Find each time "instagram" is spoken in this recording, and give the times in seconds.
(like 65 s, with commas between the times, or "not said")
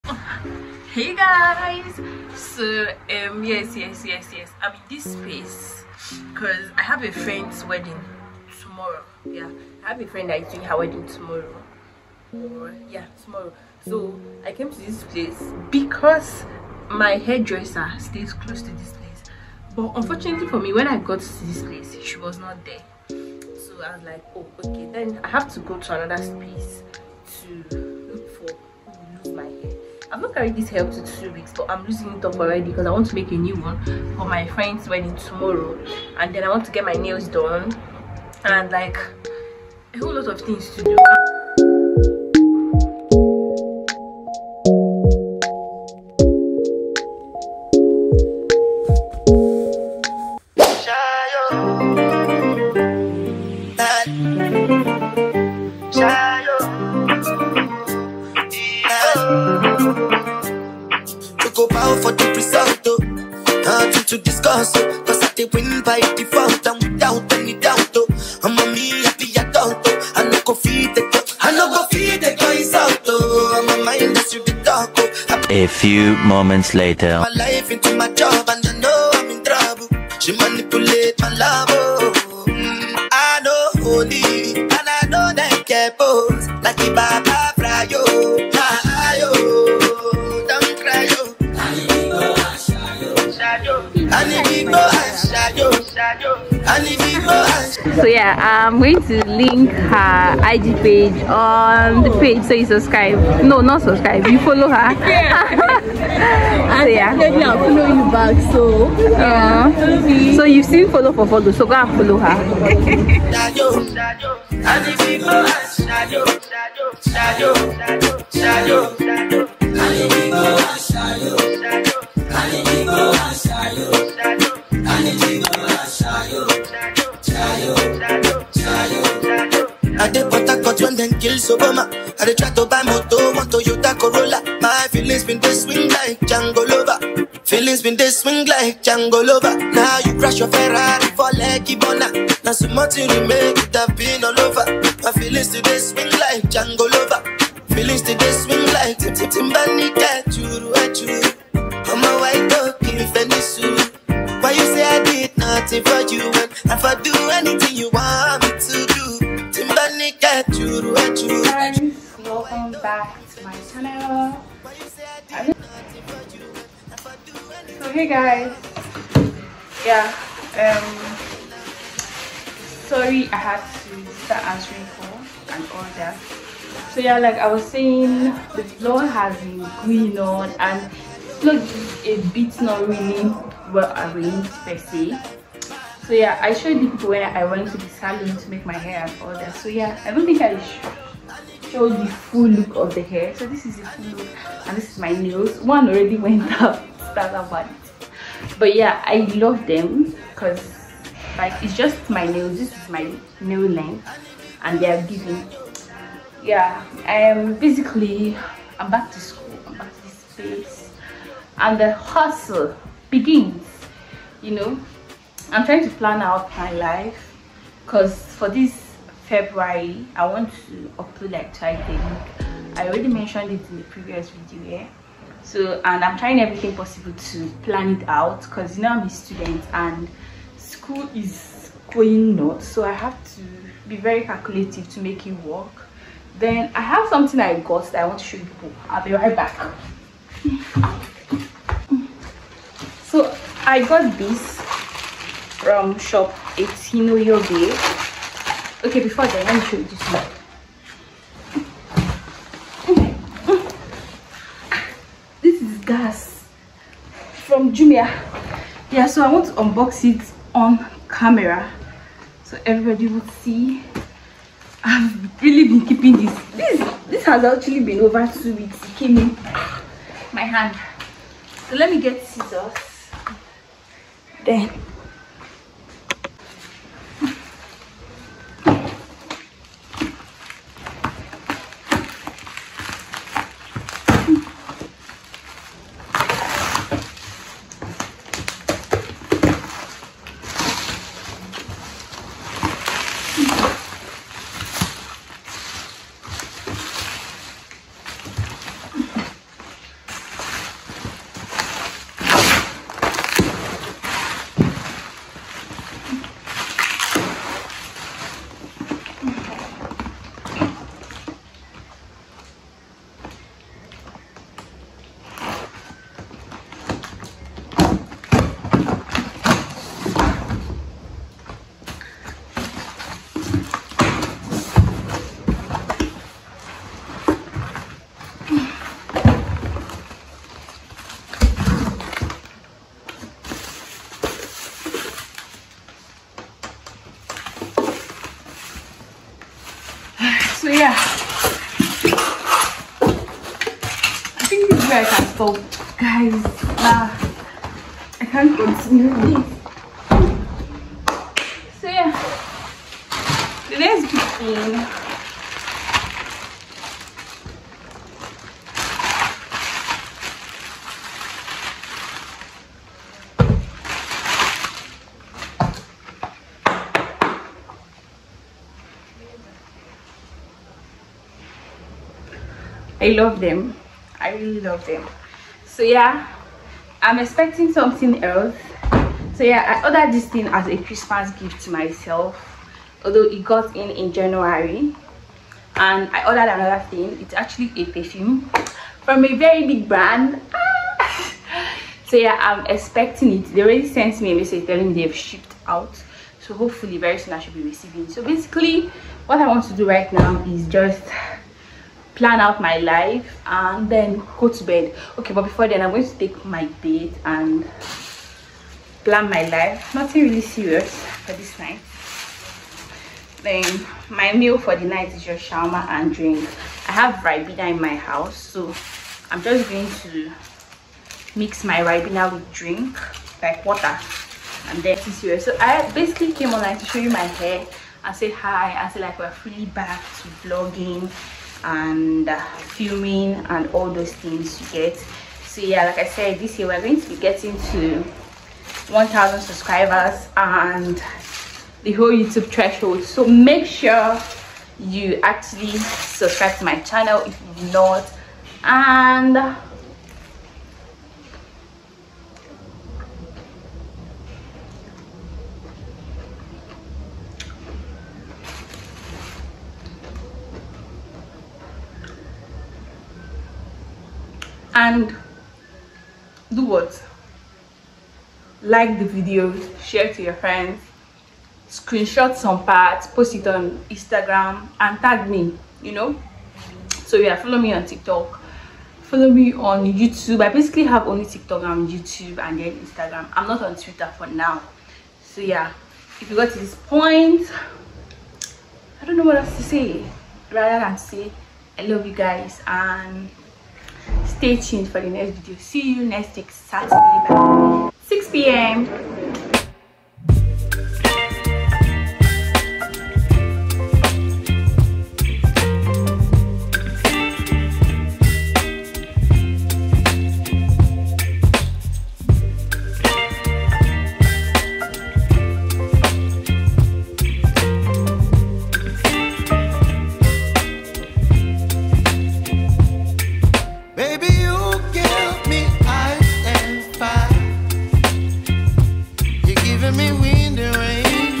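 473 s, 482 s.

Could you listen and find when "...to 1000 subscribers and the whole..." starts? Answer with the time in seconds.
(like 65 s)
437 s.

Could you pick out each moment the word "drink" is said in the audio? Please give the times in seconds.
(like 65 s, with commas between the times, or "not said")
416 s, 422 s.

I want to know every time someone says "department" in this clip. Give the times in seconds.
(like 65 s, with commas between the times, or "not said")
not said.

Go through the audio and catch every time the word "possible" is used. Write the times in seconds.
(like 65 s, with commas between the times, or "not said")
226 s.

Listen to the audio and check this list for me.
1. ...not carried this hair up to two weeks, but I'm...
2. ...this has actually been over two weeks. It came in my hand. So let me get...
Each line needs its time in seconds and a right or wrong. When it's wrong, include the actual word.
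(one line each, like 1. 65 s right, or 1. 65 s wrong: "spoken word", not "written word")
1. 30 s right
2. 267 s right.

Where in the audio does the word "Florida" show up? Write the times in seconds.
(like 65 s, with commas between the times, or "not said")
not said.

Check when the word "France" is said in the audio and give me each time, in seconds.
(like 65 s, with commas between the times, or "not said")
not said.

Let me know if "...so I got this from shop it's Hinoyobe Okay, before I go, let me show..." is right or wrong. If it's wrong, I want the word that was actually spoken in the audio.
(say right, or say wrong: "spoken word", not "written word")
right.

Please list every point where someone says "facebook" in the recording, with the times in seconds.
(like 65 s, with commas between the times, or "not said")
not said.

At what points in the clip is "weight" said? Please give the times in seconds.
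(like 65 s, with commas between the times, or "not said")
not said.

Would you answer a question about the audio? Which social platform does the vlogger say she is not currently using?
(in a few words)
Twitter.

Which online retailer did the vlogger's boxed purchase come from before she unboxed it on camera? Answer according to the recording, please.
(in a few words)
Jumia.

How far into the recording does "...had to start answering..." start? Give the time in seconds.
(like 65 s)
173 s.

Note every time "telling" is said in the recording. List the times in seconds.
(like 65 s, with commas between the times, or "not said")
394 s.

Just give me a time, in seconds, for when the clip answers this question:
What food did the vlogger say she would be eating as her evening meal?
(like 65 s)
415 s.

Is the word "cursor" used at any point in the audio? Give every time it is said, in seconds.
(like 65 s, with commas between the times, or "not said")
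not said.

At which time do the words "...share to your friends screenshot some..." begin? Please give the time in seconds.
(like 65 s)
469 s.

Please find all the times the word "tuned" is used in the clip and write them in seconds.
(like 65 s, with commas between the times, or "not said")
494 s.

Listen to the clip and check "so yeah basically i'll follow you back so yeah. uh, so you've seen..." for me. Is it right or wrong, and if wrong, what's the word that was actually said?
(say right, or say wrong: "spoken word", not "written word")
wrong: "definitely", not "basically".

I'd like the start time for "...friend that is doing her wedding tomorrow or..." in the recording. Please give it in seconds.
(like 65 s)
10 s.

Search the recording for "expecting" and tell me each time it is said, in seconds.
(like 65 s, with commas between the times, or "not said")
377 s, 392 s.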